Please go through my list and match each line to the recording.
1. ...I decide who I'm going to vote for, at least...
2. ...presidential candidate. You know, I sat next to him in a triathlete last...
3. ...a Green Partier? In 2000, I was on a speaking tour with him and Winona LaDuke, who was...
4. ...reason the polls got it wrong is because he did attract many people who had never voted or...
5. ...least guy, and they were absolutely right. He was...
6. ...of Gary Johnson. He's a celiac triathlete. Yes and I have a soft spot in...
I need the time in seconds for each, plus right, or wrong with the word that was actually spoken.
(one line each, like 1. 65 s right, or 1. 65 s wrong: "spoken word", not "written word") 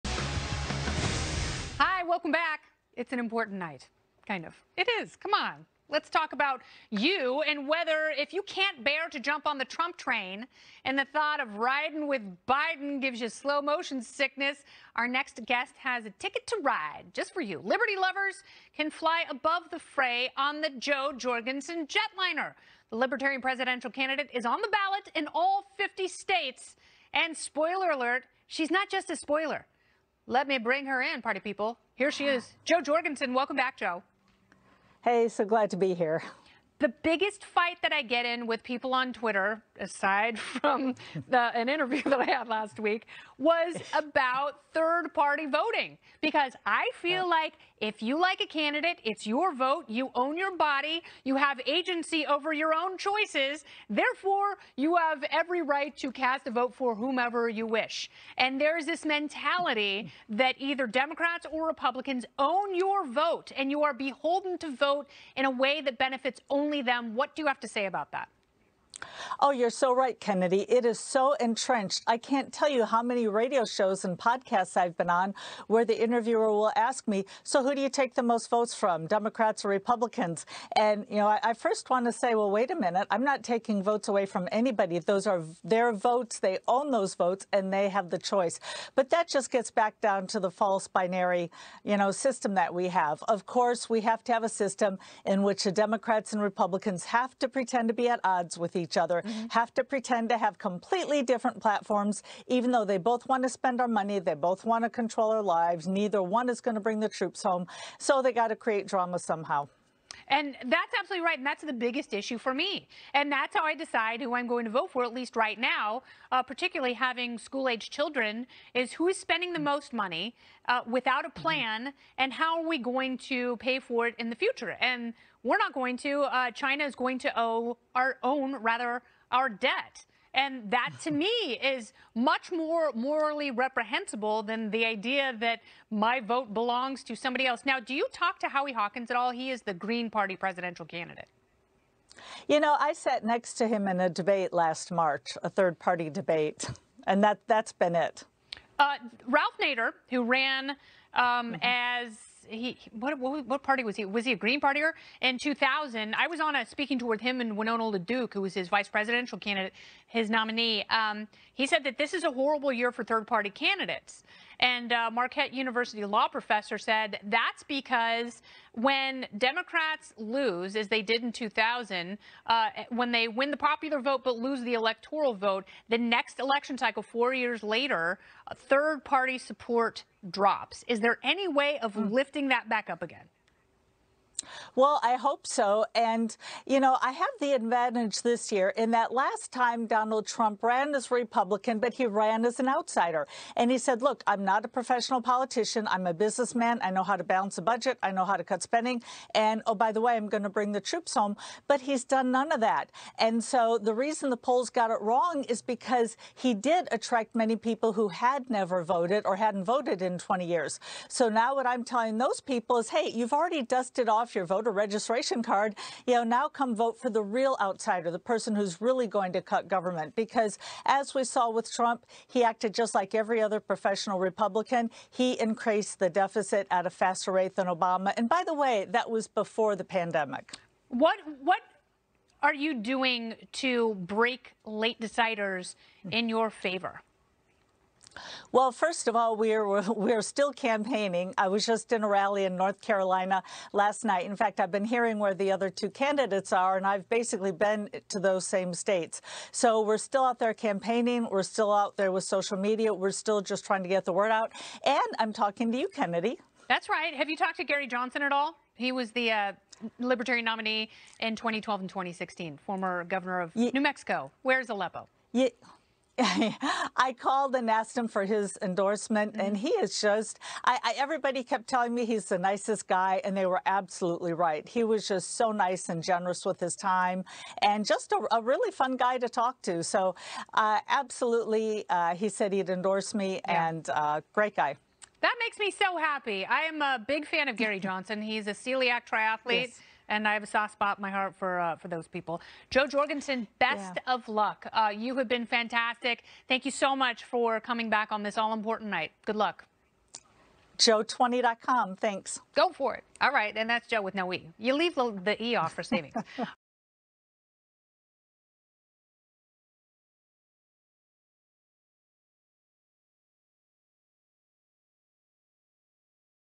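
1. 113 s right
2. 140 s wrong: "debate", not "triathlete"
3. 154 s right
4. 203 s right
5. 272 s wrong: "nicest", not "least"
6. 287 s right.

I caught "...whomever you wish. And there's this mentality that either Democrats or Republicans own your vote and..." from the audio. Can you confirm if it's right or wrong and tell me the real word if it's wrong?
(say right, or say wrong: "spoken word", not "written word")
right.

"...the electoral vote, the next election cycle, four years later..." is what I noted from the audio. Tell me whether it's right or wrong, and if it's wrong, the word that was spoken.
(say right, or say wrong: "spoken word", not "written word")
right.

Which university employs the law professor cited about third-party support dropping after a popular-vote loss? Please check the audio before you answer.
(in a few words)
Marquette University.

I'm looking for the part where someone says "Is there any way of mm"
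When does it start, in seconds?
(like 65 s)
180 s.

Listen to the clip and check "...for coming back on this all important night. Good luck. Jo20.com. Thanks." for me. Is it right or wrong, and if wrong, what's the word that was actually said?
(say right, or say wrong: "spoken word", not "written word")
right.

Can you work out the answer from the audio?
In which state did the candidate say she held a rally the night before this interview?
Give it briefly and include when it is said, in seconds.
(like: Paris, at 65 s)
North Carolina, at 242 s.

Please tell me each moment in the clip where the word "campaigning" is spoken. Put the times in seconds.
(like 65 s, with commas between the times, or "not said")
240 s, 250 s.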